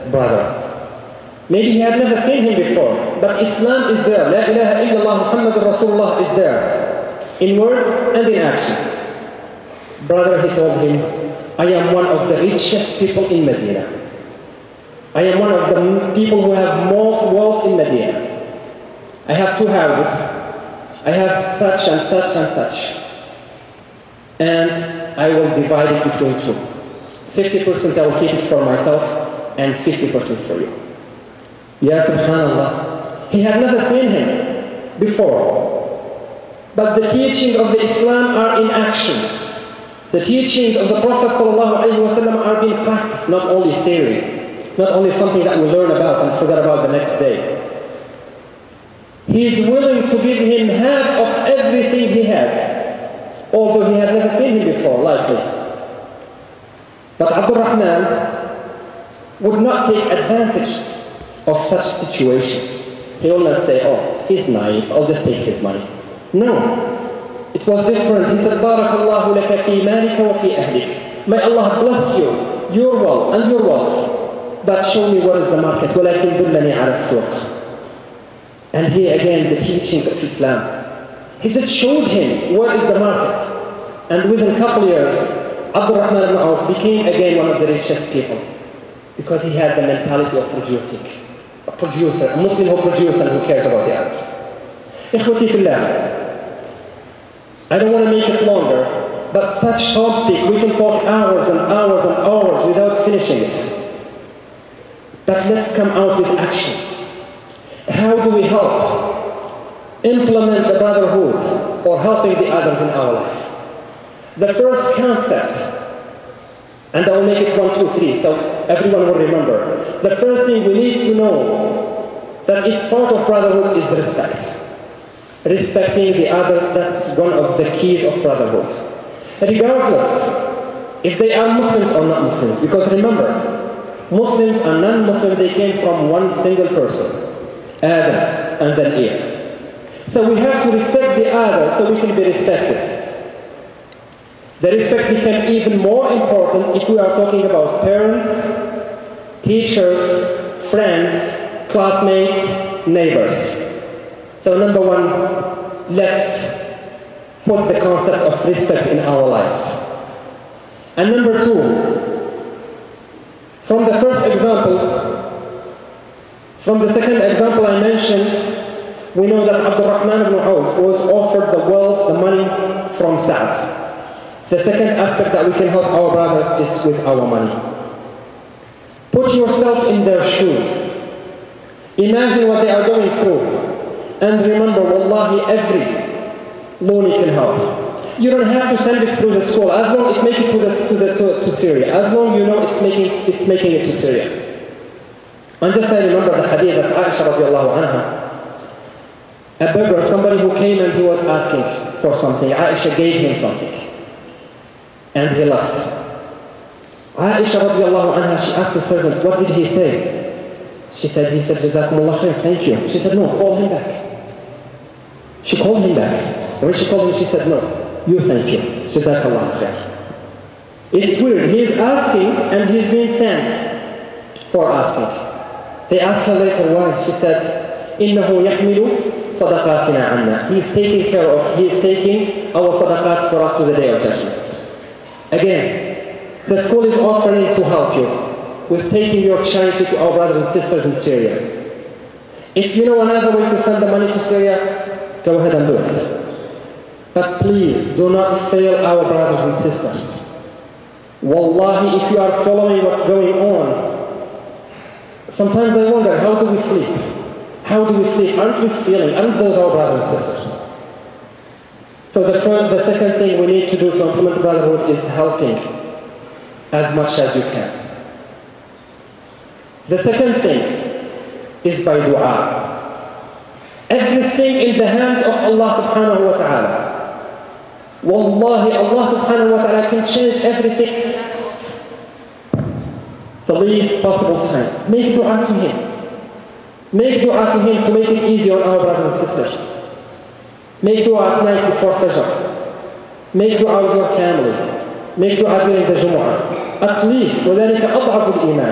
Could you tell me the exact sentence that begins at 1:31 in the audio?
A producer, a Muslim who produces and who cares about the others.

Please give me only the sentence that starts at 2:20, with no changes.
So we have to respect the other so we can be respected.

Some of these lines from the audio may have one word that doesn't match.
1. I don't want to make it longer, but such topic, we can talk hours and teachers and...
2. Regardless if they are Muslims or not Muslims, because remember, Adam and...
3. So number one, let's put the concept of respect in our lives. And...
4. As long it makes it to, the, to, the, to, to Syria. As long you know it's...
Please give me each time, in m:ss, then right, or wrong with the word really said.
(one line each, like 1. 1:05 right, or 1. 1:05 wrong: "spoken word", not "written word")
1. 1:37 wrong: "hours", not "teachers"
2. 2:09 wrong: "Muslims", not "Adam"
3. 2:34 right
4. 3:09 right.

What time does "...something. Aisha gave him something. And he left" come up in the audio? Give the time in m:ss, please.
3:22.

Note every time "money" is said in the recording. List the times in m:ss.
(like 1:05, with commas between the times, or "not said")
1:05, 2:52, 2:57, 4:03.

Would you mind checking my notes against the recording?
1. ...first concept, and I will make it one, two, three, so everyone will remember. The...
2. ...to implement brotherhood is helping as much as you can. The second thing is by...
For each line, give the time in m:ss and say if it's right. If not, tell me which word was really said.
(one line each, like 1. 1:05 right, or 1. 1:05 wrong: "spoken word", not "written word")
1. 1:54 right
2. 4:23 right.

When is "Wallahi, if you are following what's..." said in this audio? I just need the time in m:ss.
4:11.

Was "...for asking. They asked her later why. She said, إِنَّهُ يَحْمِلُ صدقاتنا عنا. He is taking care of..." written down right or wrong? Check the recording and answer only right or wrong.
right.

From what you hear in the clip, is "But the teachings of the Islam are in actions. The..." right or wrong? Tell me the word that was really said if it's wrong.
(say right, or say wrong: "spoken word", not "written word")
right.